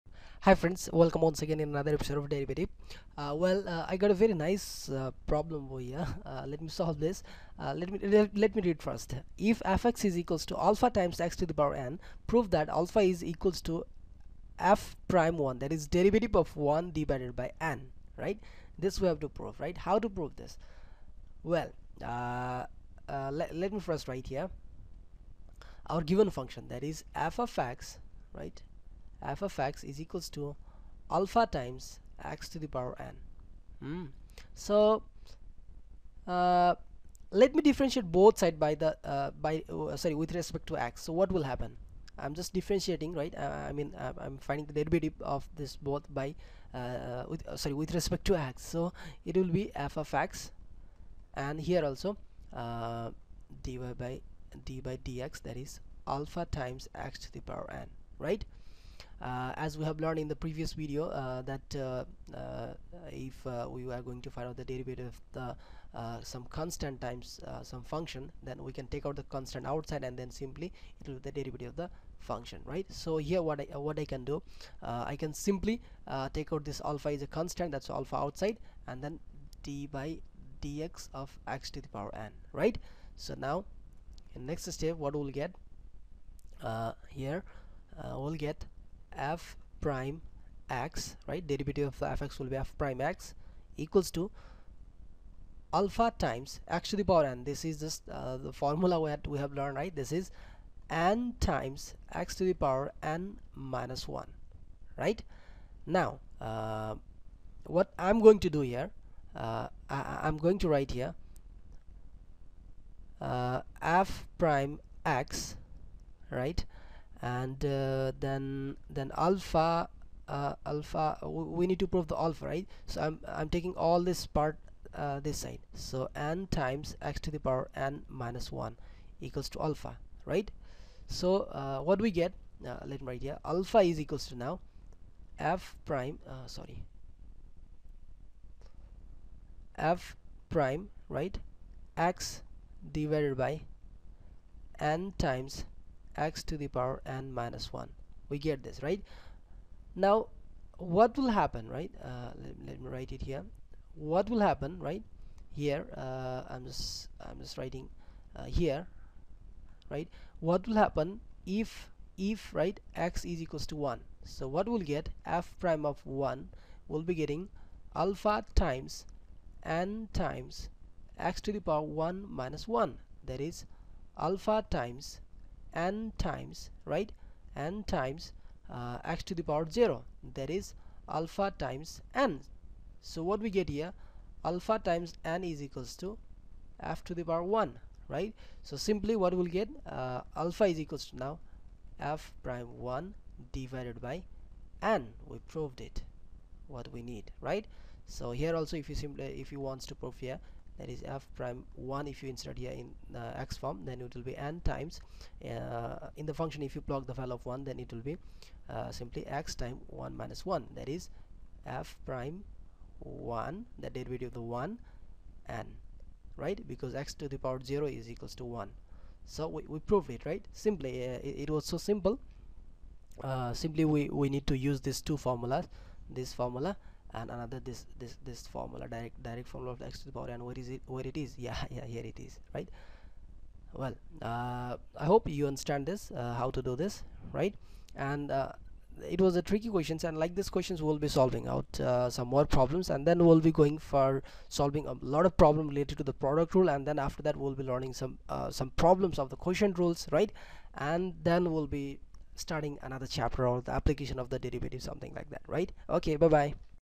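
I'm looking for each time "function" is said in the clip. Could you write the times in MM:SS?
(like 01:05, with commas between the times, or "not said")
00:26, 01:07, 01:12, 03:26.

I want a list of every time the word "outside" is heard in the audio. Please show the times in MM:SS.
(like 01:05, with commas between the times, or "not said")
01:09, 01:18.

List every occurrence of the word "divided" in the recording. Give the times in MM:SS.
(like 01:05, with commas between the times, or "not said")
00:16, 02:22, 03:13.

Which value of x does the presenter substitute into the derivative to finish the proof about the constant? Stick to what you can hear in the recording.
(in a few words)
1.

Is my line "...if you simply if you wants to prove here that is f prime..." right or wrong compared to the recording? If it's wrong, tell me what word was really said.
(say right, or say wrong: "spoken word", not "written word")
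right.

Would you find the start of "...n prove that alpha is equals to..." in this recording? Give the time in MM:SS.
00:11.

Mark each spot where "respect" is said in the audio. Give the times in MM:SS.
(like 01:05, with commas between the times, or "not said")
00:40, 00:47.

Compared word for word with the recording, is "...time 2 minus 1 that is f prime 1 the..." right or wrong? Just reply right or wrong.
wrong.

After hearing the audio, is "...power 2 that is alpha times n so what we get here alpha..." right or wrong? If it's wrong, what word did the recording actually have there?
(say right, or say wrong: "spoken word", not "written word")
wrong: "0", not "2".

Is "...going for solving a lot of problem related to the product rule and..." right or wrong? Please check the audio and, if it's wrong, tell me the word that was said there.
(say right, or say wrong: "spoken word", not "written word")
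right.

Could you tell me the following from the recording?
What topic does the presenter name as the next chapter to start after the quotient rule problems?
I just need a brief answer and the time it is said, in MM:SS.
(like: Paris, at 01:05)
application of the derivative, at 04:13.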